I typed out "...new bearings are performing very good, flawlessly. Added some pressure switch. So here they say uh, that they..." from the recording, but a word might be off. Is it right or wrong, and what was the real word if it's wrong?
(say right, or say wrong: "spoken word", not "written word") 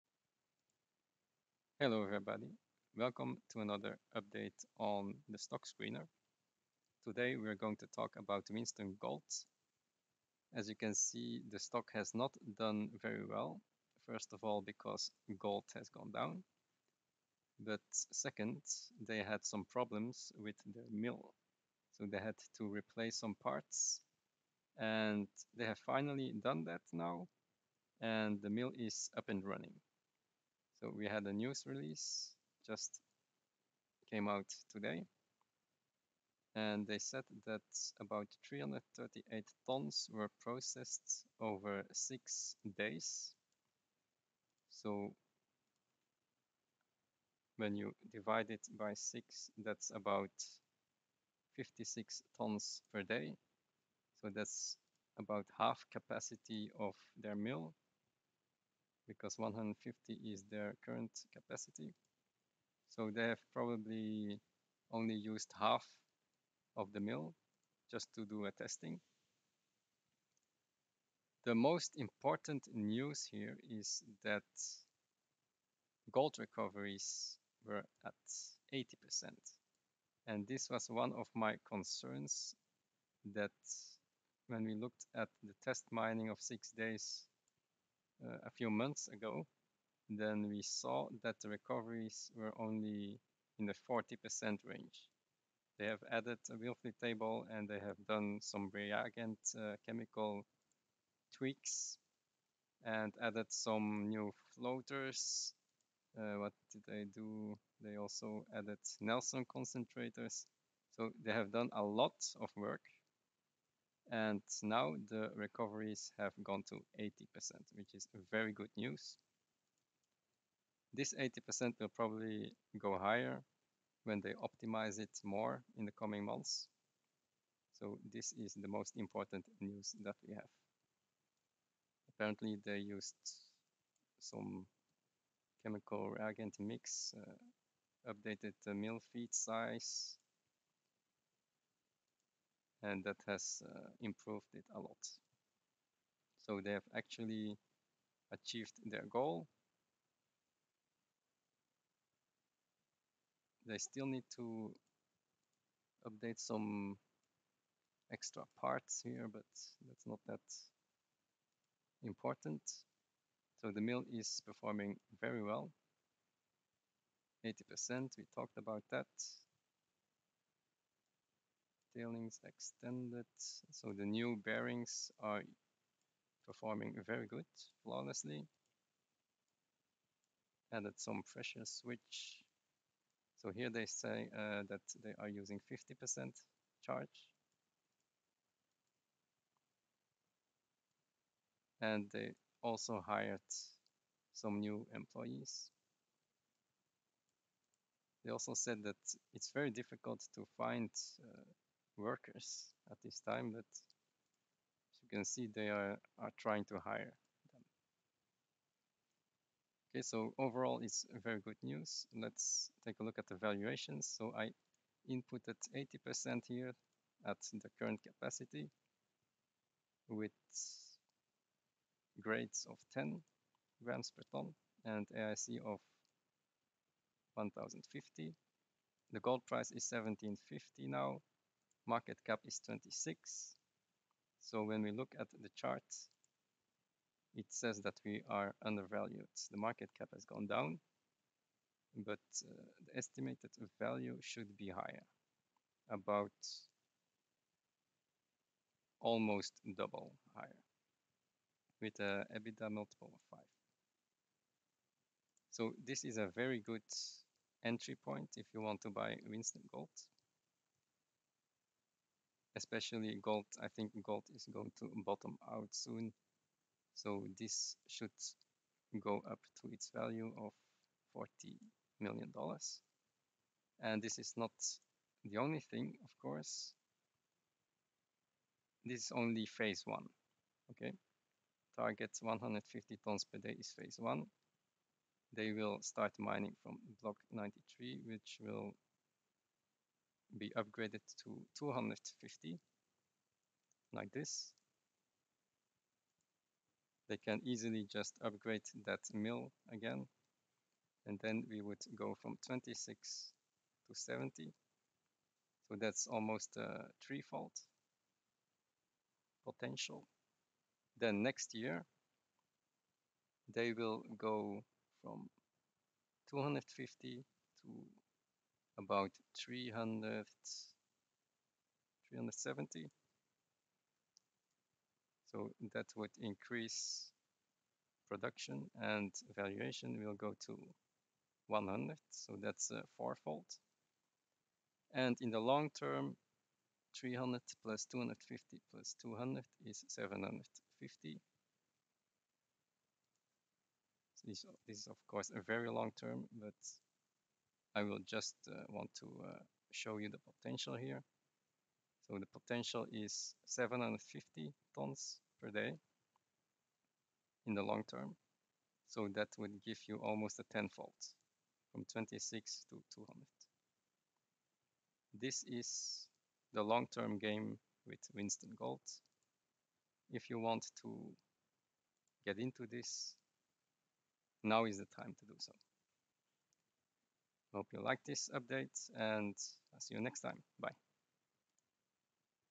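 right.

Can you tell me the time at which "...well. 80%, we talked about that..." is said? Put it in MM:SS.
02:45.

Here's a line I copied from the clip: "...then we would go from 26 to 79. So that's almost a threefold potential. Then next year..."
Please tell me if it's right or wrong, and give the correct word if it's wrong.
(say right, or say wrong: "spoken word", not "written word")
wrong: "70", not "79".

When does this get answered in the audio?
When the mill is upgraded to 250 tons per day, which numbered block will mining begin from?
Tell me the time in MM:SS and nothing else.
04:47.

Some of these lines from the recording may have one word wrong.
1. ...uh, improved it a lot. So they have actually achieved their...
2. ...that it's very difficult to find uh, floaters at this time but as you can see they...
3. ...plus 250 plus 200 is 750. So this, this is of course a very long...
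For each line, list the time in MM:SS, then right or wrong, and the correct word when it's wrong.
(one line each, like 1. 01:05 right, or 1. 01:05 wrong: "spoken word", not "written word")
1. 02:23 right
2. 03:18 wrong: "workers", not "floaters"
3. 05:37 right.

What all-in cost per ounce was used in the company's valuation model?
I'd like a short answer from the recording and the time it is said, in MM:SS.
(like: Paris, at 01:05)
1050, at 03:47.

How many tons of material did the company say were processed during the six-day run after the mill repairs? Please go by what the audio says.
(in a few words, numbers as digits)
338.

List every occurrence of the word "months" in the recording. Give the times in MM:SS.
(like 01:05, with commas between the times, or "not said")
01:28, 02:06.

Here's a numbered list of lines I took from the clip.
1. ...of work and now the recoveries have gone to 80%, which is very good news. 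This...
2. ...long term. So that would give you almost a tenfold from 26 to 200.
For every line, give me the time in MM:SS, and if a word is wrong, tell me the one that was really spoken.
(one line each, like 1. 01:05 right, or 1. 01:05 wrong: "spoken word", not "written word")
1. 01:52 right
2. 05:57 right.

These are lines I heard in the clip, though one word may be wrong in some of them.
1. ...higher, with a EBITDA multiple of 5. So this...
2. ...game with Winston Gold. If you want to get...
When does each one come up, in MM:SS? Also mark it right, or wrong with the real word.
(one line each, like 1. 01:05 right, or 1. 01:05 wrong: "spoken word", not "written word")
1. 04:10 right
2. 06:07 right.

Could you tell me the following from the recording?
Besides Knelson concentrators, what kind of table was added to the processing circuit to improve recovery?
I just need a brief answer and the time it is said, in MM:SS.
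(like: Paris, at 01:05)
Wilfley table, at 01:36.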